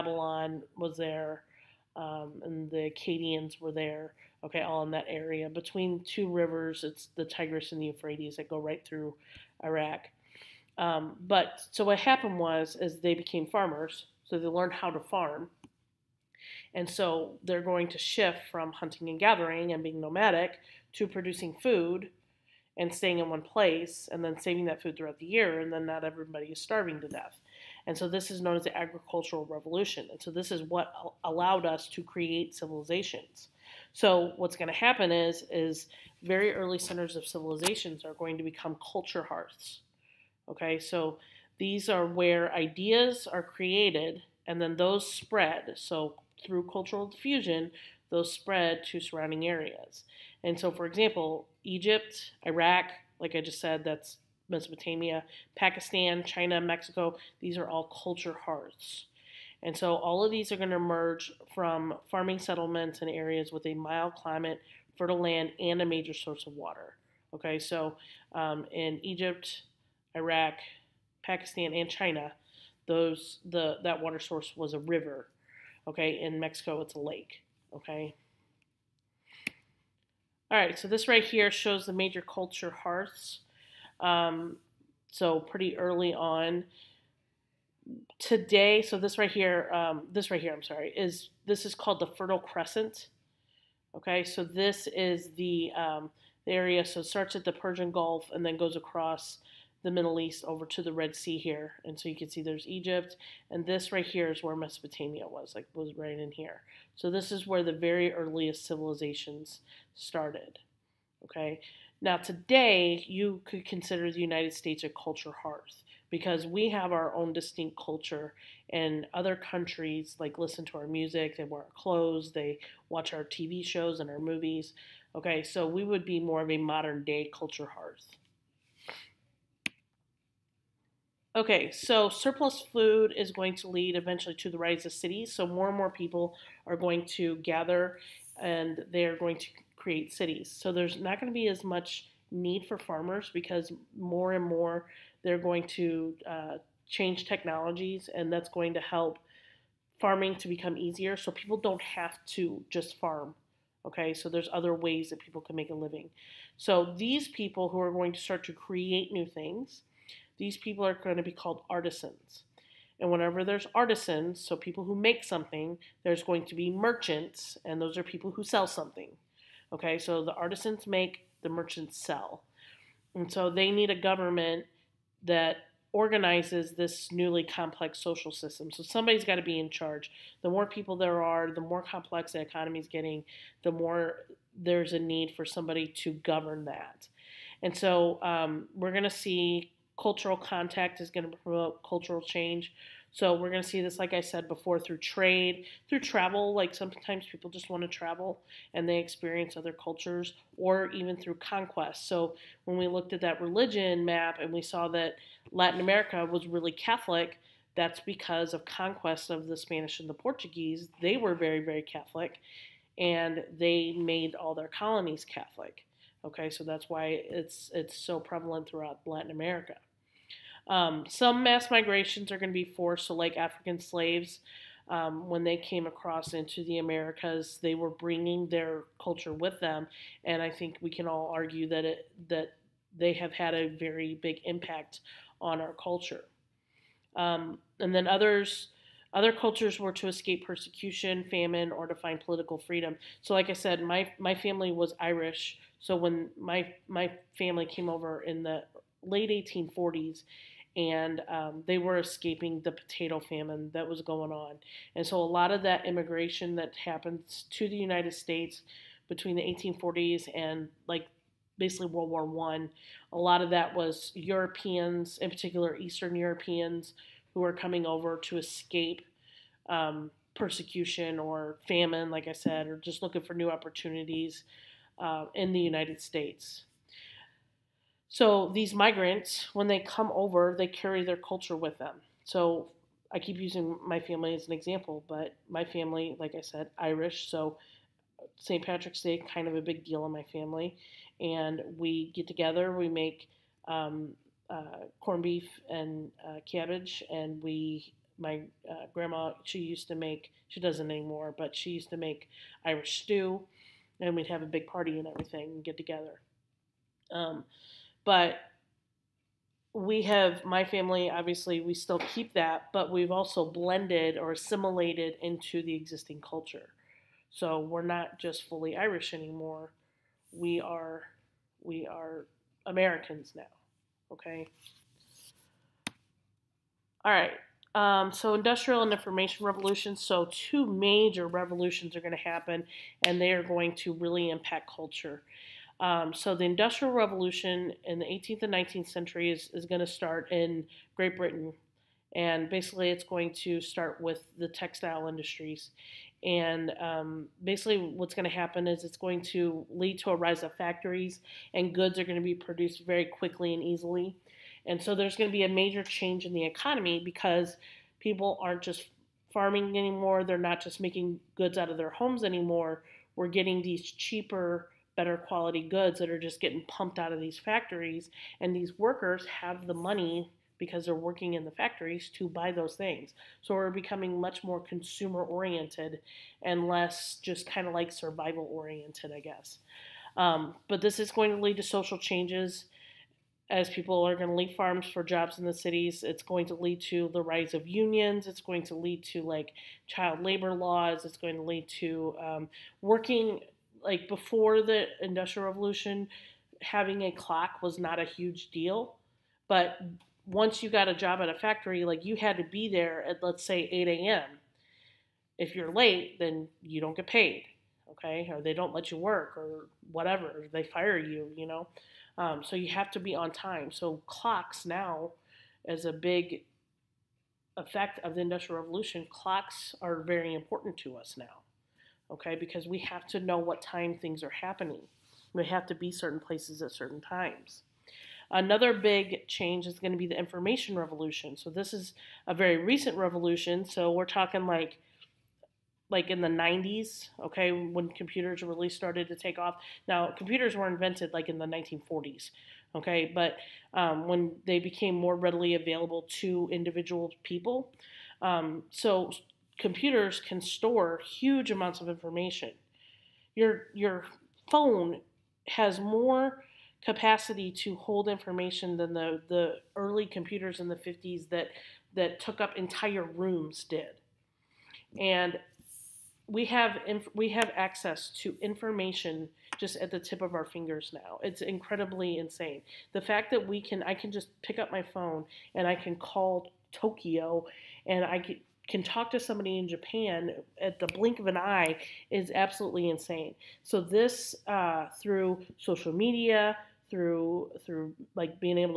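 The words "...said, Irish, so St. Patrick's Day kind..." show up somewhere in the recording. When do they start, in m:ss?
4:46.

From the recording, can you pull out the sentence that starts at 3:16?
Like sometimes people just want to travel and they experience other cultures, or even through conquest.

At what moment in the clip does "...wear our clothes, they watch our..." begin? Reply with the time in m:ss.
2:01.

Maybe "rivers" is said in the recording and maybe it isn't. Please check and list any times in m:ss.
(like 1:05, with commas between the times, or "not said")
0:06, 1:14.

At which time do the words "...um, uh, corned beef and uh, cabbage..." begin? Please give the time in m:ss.
4:53.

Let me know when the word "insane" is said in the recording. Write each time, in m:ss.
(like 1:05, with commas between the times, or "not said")
7:52, 8:02.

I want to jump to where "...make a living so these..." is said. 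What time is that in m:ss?
2:35.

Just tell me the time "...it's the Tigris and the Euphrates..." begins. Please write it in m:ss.
0:06.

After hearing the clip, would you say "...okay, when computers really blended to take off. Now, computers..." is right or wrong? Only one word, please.
wrong.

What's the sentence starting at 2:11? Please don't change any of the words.
Okay, so surplus food is going to lead eventually to the rise of cities.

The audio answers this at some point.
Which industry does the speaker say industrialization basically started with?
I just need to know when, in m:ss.
5:44.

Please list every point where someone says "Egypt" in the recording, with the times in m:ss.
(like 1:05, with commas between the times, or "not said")
0:51, 1:09, 1:42.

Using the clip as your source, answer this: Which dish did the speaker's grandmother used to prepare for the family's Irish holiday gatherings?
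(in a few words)
Irish stew.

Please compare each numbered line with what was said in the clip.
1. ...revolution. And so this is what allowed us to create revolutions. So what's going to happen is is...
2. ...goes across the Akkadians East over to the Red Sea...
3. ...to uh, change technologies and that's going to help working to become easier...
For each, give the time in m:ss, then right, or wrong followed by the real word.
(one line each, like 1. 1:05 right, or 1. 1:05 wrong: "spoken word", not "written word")
1. 0:29 wrong: "civilizations", not "revolutions"
2. 1:38 wrong: "Middle", not "Akkadians"
3. 2:25 wrong: "farming", not "working".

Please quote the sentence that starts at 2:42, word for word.
And whenever there's artisans, so people who make something, there's going to be merchants, and those are people who sell something.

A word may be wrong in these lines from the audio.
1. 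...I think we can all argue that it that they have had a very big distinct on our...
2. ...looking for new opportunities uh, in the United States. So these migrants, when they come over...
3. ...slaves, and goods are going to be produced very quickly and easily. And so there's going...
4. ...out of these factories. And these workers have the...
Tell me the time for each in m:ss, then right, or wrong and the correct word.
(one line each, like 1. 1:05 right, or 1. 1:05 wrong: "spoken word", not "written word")
1. 3:50 wrong: "impact", not "distinct"
2. 4:33 right
3. 5:50 wrong: "factories", not "slaves"
4. 6:06 right.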